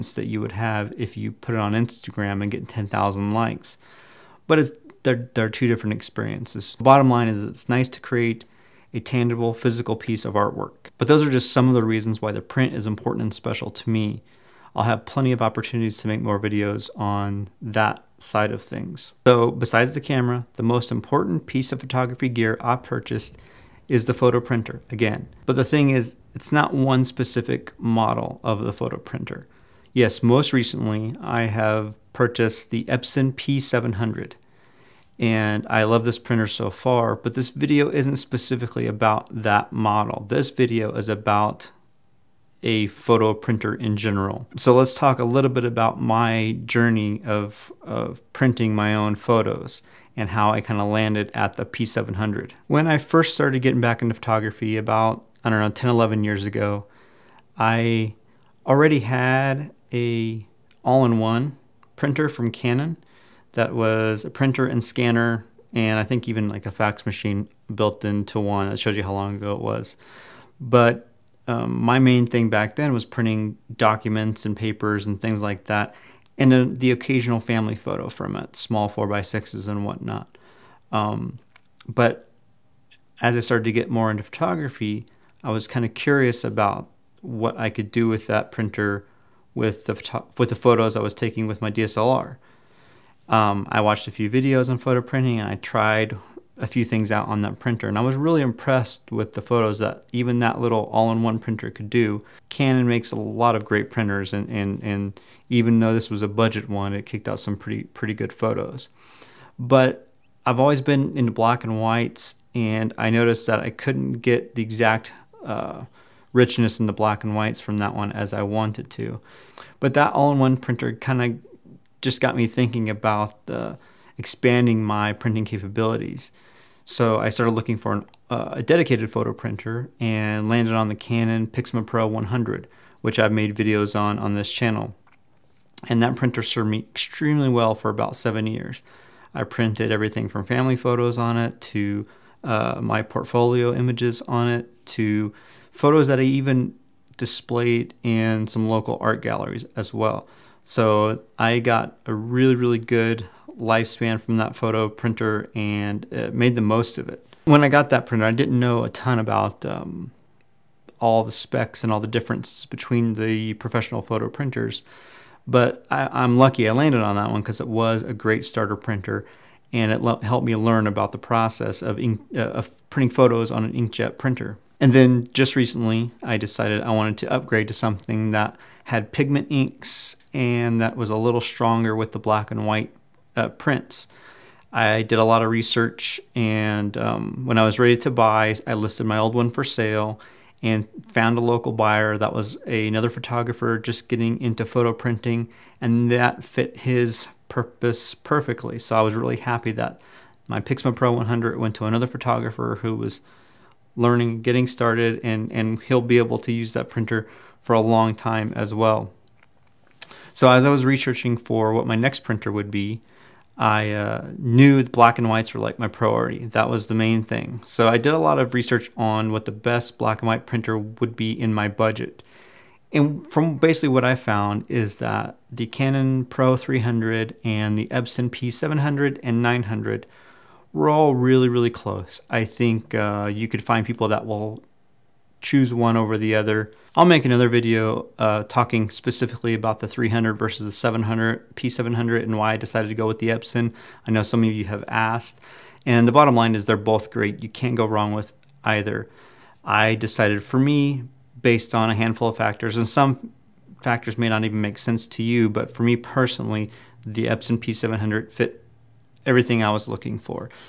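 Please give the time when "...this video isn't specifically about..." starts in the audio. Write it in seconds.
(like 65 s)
37 s.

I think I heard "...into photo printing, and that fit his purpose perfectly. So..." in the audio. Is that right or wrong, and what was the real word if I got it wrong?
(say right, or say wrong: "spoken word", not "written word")
right.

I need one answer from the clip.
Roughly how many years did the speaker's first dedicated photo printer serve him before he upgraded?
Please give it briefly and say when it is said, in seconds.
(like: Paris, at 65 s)
7, at 138 s.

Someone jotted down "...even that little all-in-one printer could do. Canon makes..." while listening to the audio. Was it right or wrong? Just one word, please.
right.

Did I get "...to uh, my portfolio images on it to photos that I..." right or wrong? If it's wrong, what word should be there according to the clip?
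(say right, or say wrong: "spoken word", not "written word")
right.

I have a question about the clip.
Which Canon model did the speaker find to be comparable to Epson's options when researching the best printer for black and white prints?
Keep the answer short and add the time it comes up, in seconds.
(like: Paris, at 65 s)
Canon Pro 300, at 225 s.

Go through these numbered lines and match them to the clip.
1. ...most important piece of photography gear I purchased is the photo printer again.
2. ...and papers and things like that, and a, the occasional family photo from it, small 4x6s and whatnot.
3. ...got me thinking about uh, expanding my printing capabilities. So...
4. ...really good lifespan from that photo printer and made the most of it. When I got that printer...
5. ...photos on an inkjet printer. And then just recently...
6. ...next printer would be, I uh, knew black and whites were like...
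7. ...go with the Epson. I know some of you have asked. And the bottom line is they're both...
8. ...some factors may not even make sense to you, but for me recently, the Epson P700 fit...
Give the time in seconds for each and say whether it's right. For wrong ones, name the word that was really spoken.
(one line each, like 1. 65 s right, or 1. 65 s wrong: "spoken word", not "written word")
1. 20 s right
2. 74 s right
3. 122 s right
4. 152 s right
5. 173 s right
6. 211 s right
7. 242 s right
8. 252 s wrong: "personally", not "recently".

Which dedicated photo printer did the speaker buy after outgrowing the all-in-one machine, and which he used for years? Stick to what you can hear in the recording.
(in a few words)
Canon Pixma Pro 100.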